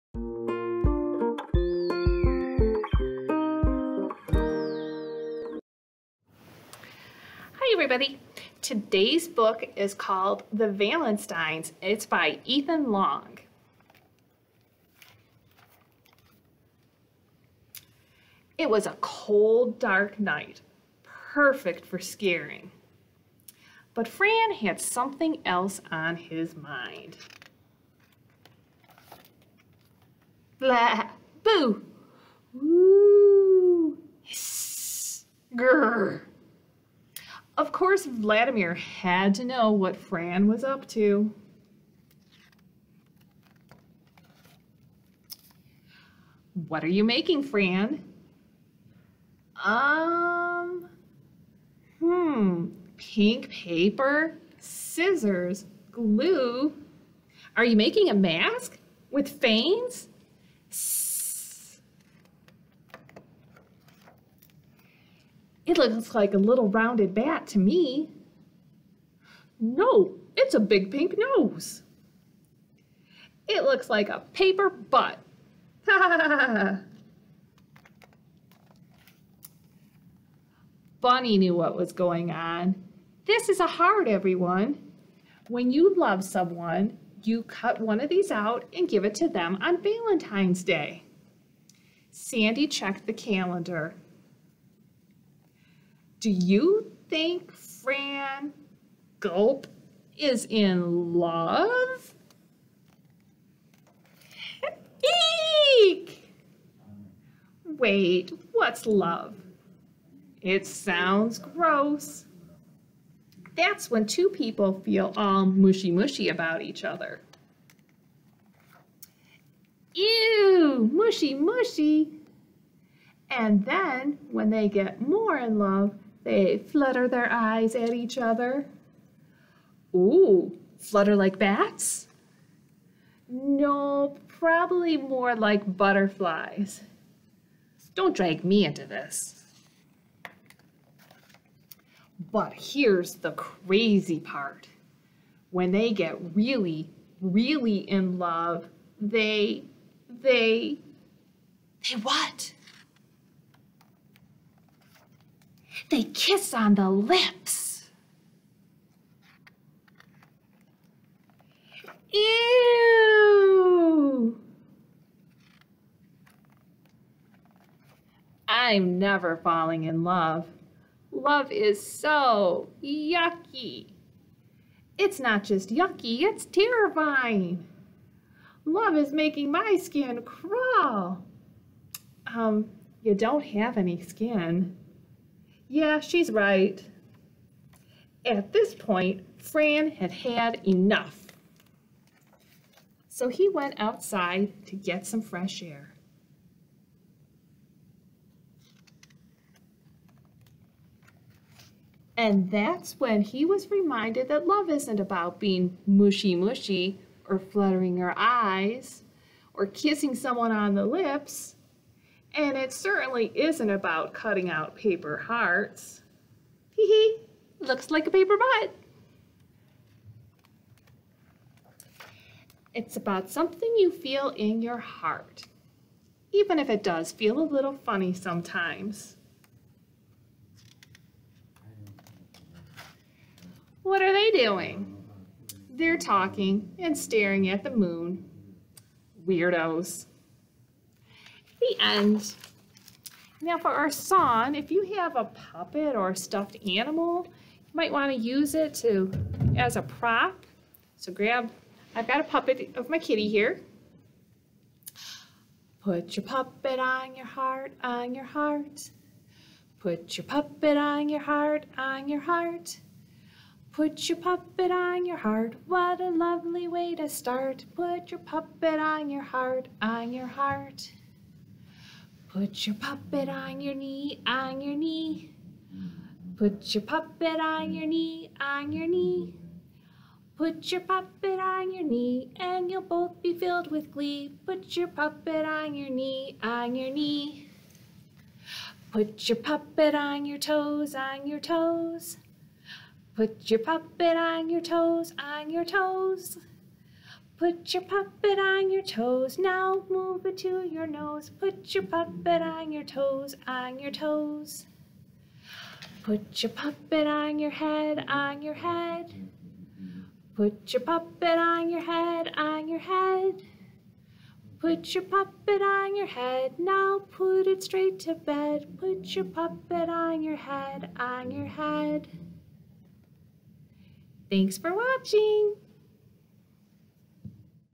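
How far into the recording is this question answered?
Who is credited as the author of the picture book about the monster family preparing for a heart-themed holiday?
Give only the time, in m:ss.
0:12.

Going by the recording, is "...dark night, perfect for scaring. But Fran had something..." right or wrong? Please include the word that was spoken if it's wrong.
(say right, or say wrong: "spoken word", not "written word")
right.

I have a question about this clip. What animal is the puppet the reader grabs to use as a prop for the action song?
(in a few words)
Kitty.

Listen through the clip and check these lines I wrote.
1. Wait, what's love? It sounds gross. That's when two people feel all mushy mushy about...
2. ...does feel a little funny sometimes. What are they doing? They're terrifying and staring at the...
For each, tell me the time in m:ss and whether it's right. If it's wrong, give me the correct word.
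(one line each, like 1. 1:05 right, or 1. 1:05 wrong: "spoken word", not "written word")
1. 1:47 right
2. 3:46 wrong: "talking", not "terrifying".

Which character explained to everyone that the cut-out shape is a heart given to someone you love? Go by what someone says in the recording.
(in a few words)
Bunny.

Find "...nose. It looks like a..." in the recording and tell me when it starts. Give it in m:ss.
1:11.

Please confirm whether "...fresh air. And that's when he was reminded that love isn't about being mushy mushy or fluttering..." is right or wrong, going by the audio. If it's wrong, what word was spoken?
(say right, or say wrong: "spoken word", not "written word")
right.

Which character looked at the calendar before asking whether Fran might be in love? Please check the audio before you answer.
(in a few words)
Sandy.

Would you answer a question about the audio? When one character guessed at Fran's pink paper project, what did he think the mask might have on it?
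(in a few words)
Veins.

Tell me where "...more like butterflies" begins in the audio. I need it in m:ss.
2:14.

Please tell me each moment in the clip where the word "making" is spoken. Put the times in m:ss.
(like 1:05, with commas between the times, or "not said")
0:47, 0:57, 2:59.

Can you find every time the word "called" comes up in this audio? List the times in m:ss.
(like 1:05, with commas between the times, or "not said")
0:09.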